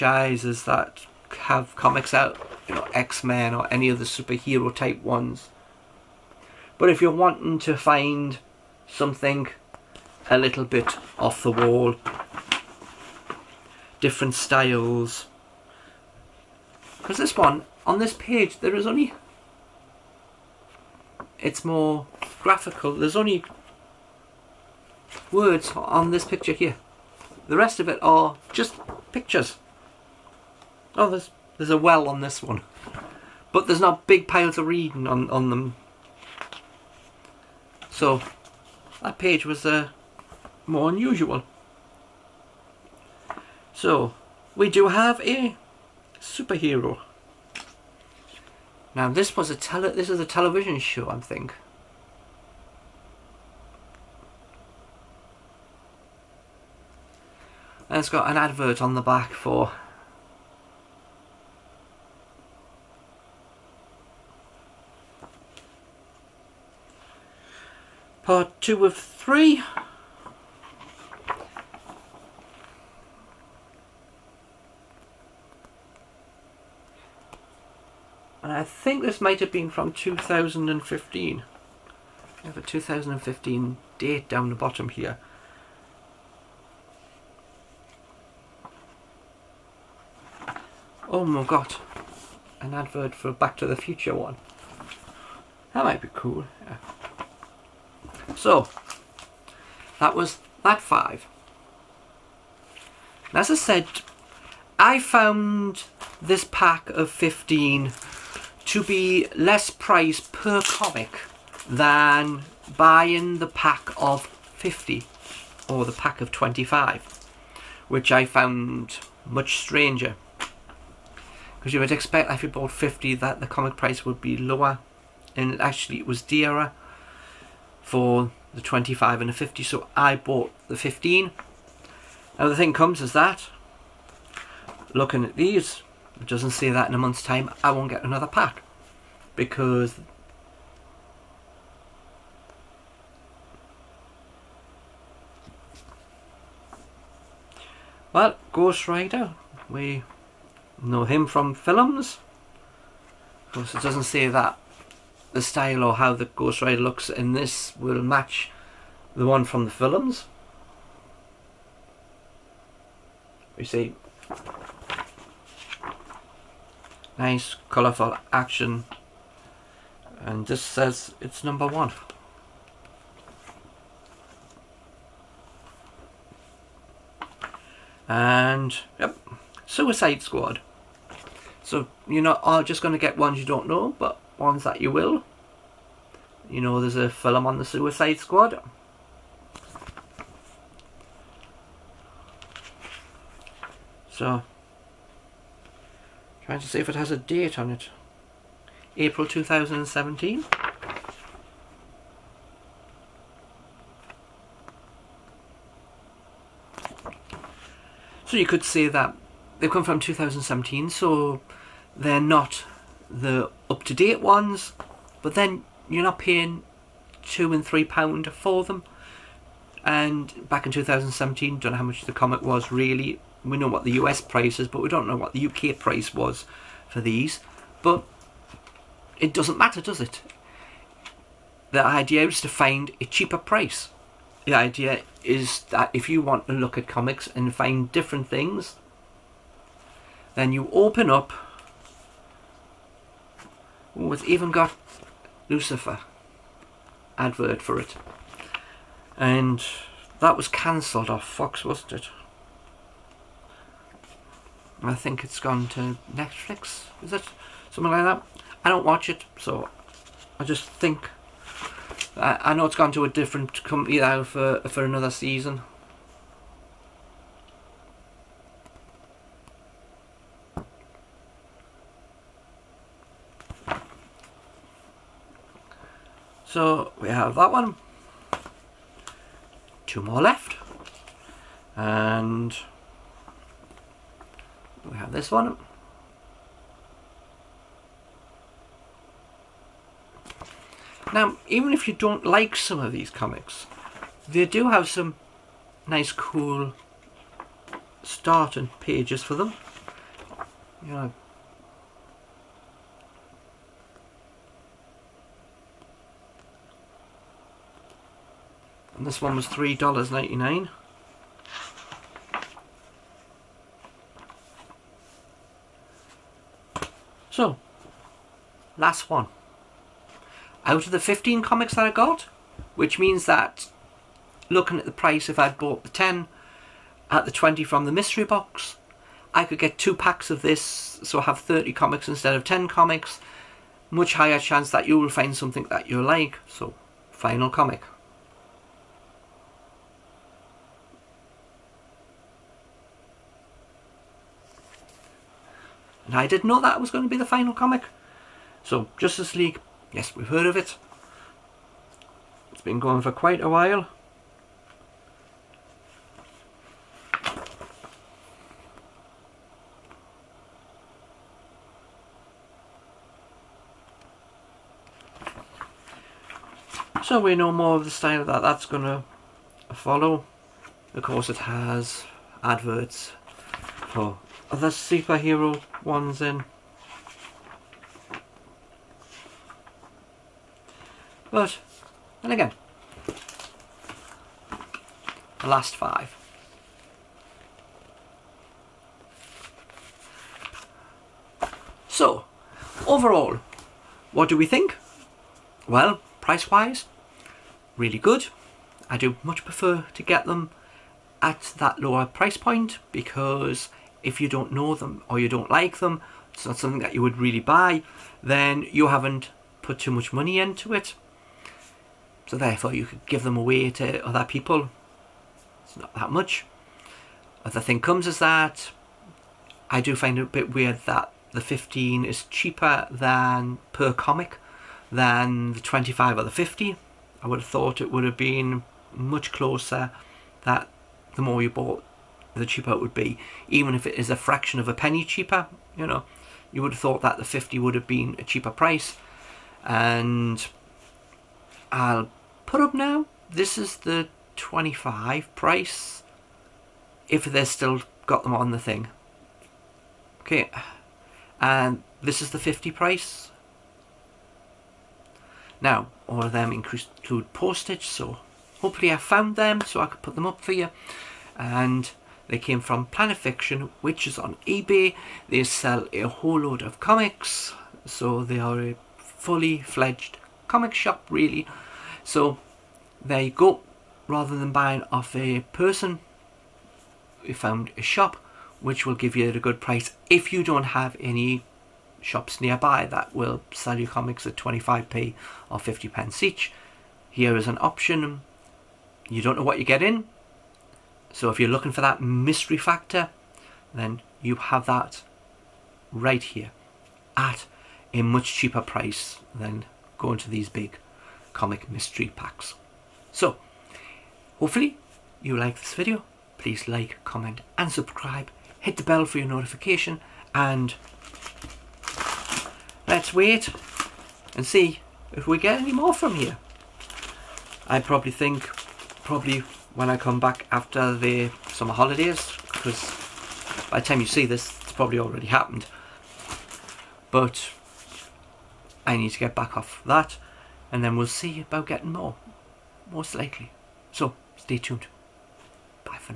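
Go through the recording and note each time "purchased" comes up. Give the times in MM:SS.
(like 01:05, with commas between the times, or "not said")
not said.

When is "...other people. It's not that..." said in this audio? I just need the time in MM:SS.
06:54.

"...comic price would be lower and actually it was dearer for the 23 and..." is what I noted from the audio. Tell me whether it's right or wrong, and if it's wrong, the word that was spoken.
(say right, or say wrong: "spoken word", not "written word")
wrong: "25", not "23".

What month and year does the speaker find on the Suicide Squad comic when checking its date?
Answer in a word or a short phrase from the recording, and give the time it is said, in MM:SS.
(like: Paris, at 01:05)
April 2017, at 03:18.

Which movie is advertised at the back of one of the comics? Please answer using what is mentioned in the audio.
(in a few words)
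Back to the Future.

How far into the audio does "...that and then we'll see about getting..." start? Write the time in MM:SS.
08:49.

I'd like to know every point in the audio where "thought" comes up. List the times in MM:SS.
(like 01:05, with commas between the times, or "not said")
07:07, 07:16.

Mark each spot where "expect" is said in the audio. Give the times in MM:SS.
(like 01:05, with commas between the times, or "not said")
02:01.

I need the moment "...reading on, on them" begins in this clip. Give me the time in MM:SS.
00:34.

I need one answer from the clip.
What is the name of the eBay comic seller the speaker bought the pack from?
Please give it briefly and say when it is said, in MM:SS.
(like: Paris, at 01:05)
Planet Fiction, at 07:42.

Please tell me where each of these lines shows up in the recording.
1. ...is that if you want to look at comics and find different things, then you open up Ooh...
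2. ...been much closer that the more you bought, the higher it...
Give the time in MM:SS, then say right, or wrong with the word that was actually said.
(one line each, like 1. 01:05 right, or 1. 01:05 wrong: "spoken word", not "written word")
1. 03:55 right
2. 07:08 wrong: "cheaper", not "higher".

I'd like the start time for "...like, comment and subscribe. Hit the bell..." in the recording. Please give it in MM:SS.
08:26.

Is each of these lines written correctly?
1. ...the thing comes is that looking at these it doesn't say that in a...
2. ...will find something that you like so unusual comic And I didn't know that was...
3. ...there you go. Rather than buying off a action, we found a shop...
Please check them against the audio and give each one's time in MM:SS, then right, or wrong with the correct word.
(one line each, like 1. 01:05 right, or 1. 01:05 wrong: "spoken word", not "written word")
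1. 02:12 right
2. 05:34 wrong: "final", not "unusual"
3. 07:53 wrong: "person", not "action".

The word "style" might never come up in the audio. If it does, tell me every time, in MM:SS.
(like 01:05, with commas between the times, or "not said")
00:14, 02:35, 06:07.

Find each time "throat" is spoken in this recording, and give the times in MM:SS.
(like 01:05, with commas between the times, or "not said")
not said.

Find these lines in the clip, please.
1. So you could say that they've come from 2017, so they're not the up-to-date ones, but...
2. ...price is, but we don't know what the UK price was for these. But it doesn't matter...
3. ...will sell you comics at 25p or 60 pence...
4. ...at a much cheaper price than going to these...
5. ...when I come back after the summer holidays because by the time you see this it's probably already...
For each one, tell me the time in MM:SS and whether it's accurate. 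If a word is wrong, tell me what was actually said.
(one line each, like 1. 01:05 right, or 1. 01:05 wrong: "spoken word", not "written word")
1. 03:28 right
2. 03:44 right
3. 08:03 wrong: "50", not "60"
4. 08:17 right
5. 08:39 right.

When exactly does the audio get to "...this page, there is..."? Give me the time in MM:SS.
00:17.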